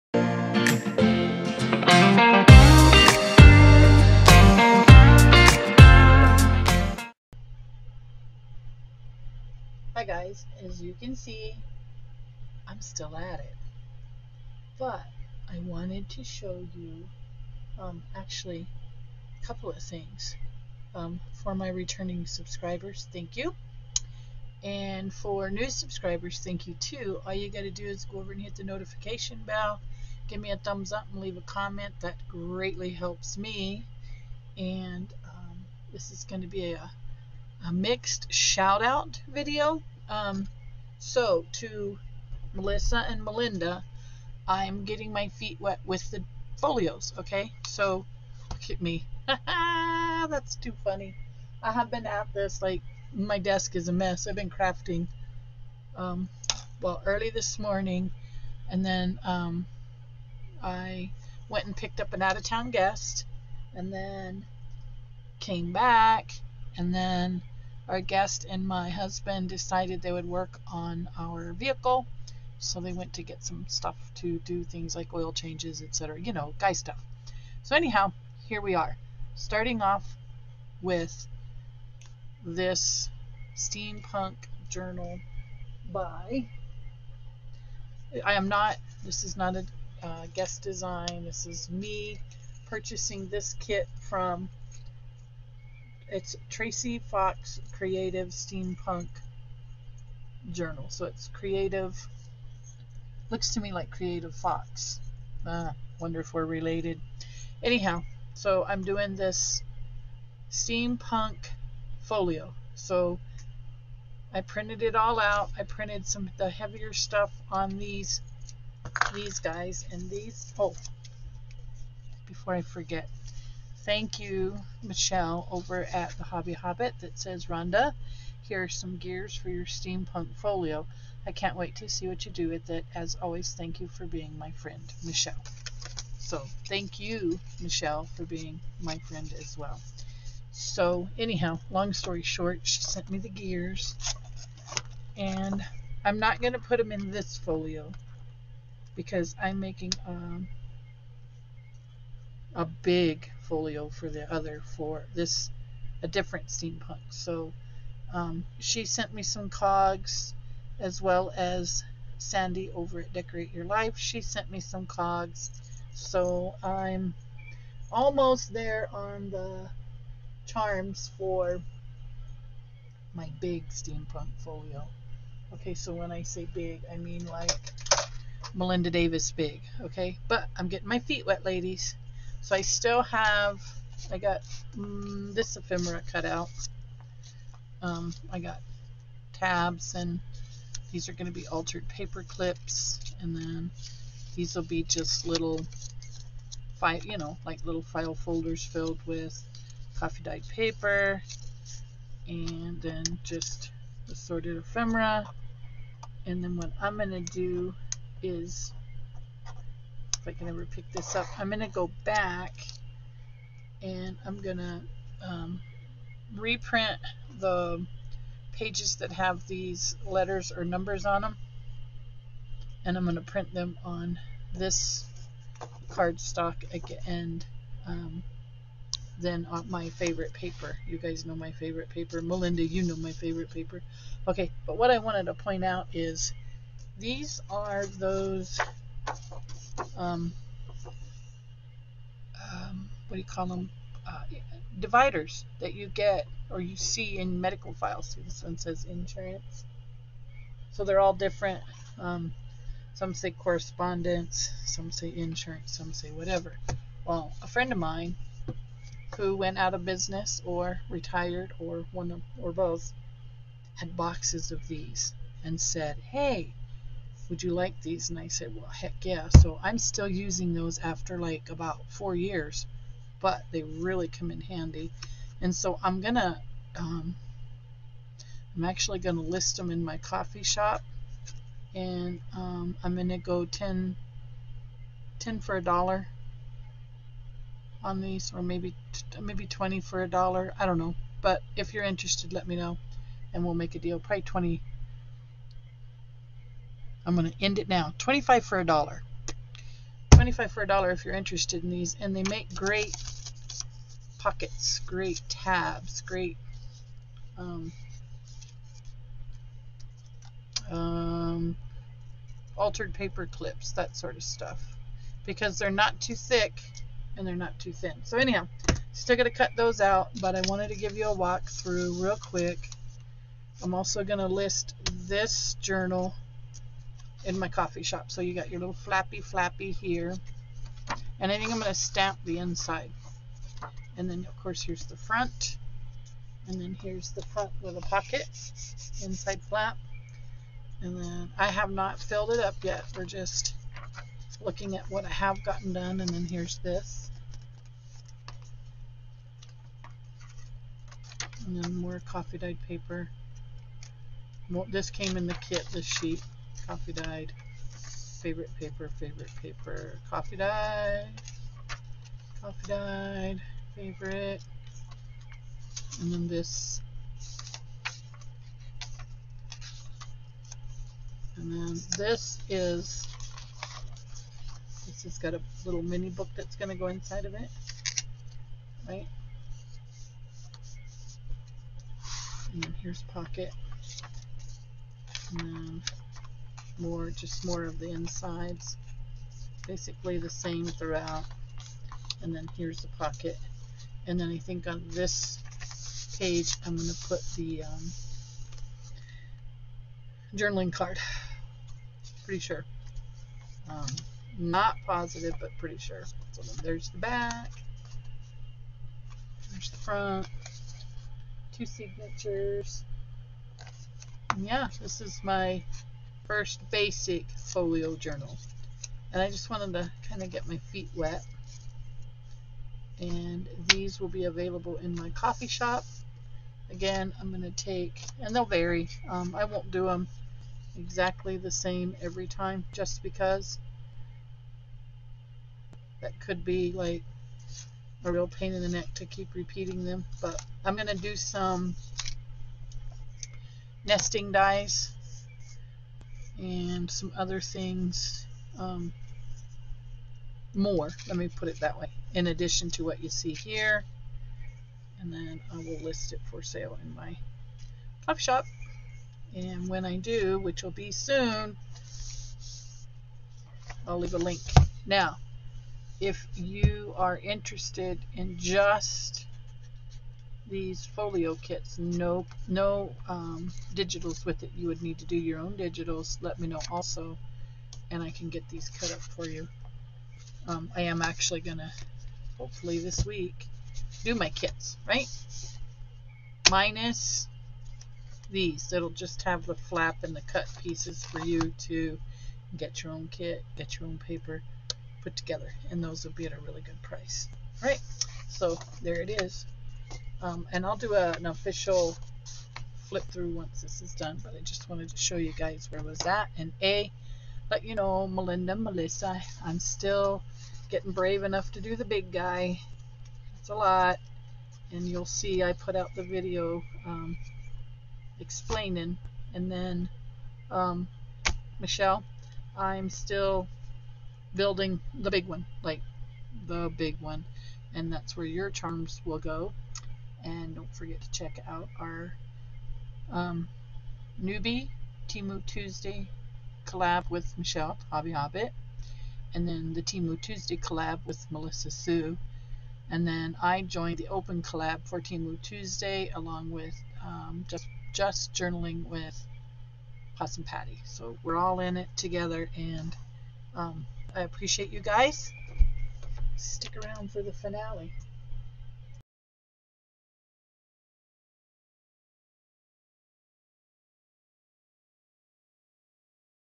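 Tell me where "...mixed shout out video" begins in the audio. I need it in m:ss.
0:37.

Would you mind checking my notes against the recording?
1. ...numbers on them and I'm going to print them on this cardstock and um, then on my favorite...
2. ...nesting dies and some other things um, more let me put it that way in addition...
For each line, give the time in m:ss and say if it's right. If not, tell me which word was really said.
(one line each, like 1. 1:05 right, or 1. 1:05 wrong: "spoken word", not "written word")
1. 3:40 right
2. 7:23 right.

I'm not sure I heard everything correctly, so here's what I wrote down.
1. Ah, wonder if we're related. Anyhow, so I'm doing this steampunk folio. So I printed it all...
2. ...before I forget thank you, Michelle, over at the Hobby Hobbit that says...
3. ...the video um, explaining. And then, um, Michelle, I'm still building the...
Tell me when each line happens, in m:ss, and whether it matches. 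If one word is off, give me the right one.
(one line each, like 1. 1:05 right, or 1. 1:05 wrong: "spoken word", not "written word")
1. 1:45 right
2. 2:02 right
3. 8:35 right.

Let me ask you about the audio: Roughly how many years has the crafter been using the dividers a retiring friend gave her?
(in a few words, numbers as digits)
4.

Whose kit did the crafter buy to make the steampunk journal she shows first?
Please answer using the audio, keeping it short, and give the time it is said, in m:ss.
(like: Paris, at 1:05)
Tracy Fox Creative, at 1:36.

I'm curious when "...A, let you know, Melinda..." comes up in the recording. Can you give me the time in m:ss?
8:26.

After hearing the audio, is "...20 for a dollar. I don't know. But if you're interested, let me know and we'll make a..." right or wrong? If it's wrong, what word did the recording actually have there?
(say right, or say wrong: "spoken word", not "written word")
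right.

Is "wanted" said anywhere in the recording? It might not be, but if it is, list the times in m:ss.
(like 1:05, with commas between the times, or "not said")
0:15, 3:54, 5:20, 6:59, 8:24.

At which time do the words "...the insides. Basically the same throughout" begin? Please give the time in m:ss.
6:27.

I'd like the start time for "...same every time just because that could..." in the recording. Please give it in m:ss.
7:11.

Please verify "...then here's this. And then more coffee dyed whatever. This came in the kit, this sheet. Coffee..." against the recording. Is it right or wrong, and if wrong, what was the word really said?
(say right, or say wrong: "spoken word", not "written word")
wrong: "paper", not "whatever".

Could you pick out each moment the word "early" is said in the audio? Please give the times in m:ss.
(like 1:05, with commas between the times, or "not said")
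0:57.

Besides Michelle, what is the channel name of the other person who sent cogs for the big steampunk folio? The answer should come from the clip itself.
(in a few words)
Decorate Your Life.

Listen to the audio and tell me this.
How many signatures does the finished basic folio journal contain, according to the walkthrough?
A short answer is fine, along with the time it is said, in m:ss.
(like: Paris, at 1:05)
2, at 6:51.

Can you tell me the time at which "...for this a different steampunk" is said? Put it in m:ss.
2:34.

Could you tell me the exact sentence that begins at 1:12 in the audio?
So they went to get some stuff to do things like oil changes, etc.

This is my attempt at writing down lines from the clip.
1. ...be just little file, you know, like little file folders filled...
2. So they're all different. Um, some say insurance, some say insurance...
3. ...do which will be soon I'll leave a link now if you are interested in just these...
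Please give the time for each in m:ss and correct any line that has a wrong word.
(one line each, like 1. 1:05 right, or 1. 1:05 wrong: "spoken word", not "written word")
1. 3:14 right
2. 4:10 wrong: "correspondence", not "insurance"
3. 7:39 right.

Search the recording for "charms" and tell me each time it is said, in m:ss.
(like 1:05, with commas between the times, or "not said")
2:50, 8:48.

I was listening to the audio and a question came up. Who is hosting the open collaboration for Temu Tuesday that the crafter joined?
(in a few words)
Possum Patty.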